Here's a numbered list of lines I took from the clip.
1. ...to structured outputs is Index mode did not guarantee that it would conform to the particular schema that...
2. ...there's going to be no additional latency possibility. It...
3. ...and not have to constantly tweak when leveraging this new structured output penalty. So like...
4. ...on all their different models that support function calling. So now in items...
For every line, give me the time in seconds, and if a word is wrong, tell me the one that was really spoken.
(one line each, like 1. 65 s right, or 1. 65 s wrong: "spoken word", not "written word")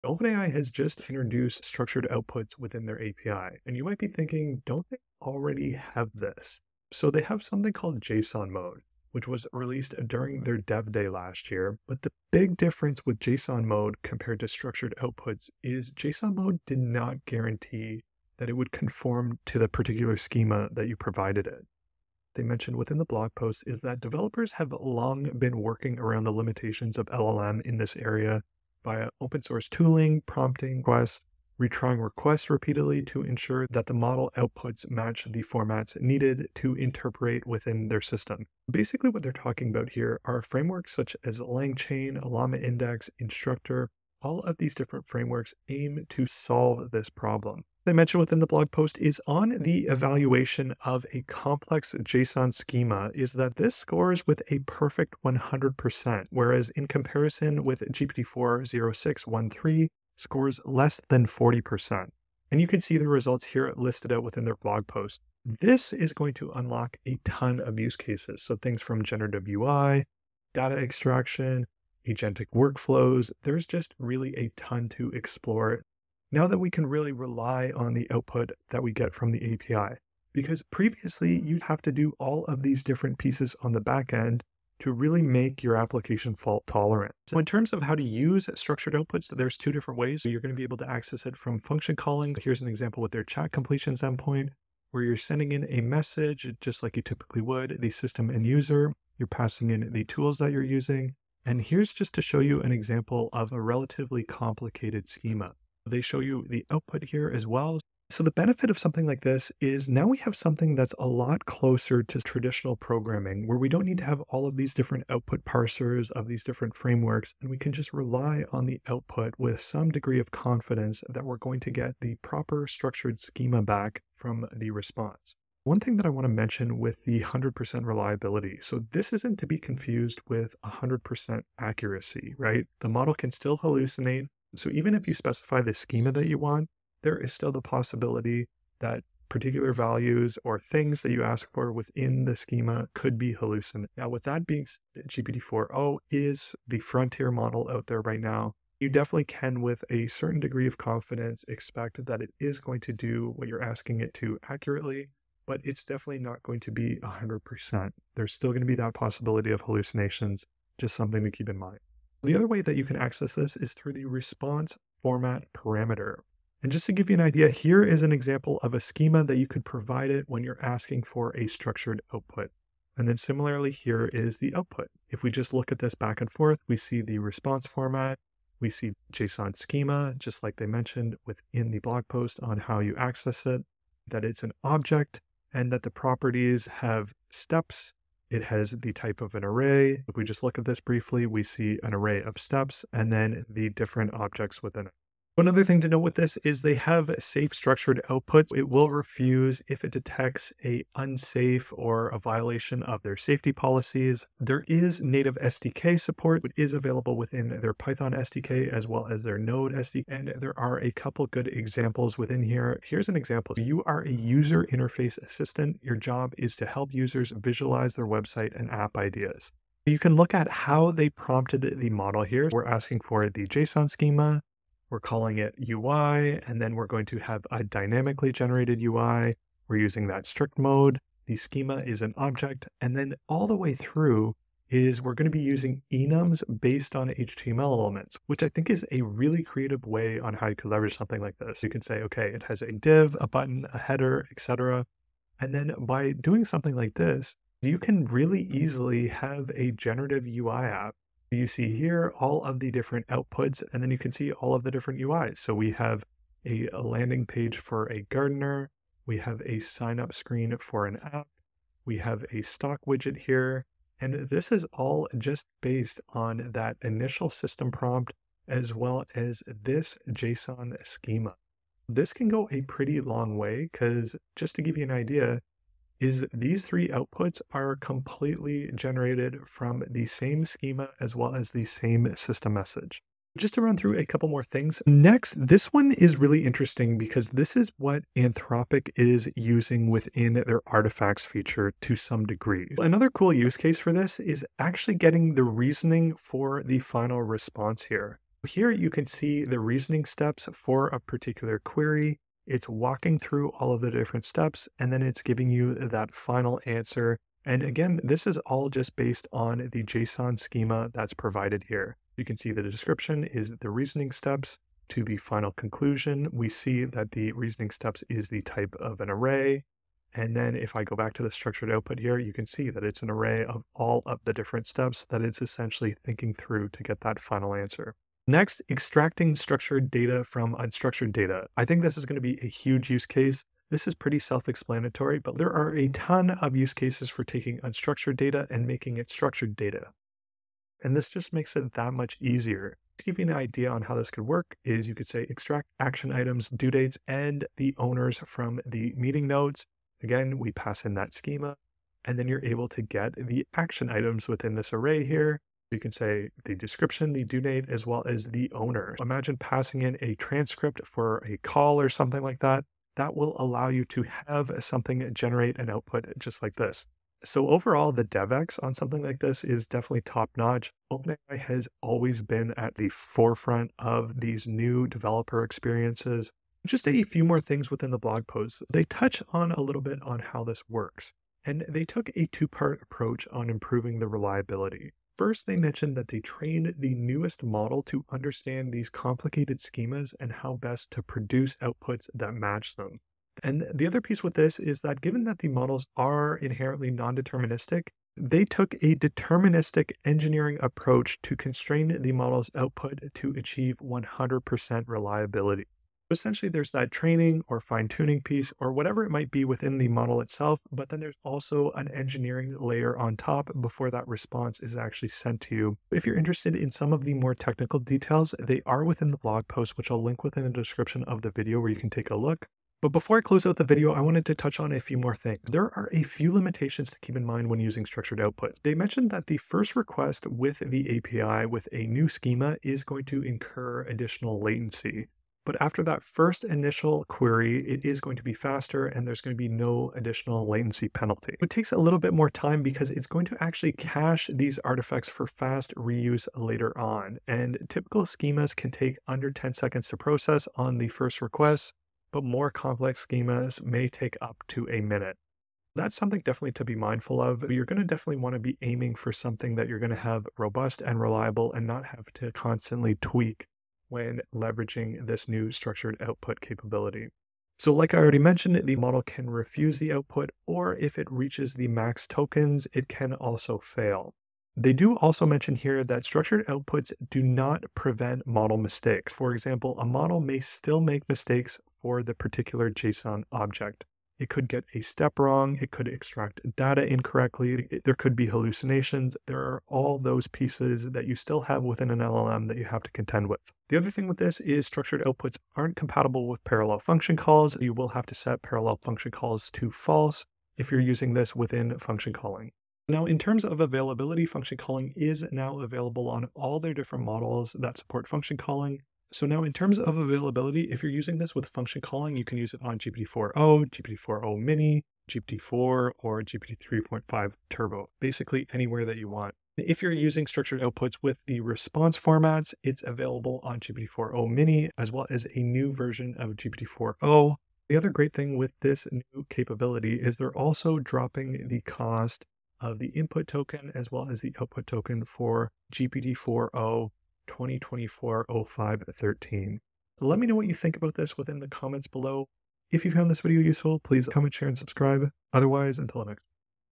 1. 14 s wrong: "JSON", not "Index"
2. 439 s wrong: "penalty", not "possibility"
3. 461 s wrong: "capability", not "penalty"
4. 506 s wrong: "terms", not "items".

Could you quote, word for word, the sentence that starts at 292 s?
Another cool use case for this is actually getting the reasoning for the final response here.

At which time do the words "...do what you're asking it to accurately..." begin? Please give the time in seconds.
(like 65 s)
152 s.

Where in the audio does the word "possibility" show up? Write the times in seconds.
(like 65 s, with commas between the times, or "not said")
137 s, 158 s.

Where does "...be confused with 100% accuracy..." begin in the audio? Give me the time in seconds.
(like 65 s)
129 s.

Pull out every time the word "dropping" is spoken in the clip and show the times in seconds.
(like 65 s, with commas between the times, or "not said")
530 s.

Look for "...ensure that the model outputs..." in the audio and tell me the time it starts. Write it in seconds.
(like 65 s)
33 s.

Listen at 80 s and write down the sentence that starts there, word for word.
Because previously, you'd have to do all of these different pieces on the back end to really make your application fault tolerant.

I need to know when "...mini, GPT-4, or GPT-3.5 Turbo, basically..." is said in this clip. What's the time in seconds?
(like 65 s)
514 s.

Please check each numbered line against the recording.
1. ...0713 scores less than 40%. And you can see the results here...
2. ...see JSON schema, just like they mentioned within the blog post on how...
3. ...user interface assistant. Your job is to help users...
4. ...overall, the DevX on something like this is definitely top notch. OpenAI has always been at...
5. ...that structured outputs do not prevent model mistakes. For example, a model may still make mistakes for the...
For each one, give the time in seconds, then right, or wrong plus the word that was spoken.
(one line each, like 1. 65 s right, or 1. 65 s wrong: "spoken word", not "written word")
1. 58 s wrong: "0613", not "0713"
2. 178 s right
3. 214 s right
4. 367 s right
5. 475 s right.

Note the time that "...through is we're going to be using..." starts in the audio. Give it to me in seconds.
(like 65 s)
233 s.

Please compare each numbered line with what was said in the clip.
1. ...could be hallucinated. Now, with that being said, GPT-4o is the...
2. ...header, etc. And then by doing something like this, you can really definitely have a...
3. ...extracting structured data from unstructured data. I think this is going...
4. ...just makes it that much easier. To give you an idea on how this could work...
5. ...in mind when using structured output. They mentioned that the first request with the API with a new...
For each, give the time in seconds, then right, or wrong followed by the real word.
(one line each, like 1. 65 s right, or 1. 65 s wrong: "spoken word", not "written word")
1. 142 s right
2. 243 s wrong: "easily", not "definitely"
3. 328 s right
4. 341 s right
5. 427 s right.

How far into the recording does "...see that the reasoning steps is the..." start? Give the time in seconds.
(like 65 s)
316 s.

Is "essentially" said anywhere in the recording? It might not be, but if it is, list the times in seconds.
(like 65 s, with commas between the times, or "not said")
325 s, 406 s.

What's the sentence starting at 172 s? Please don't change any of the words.
And then similarly, here is the output.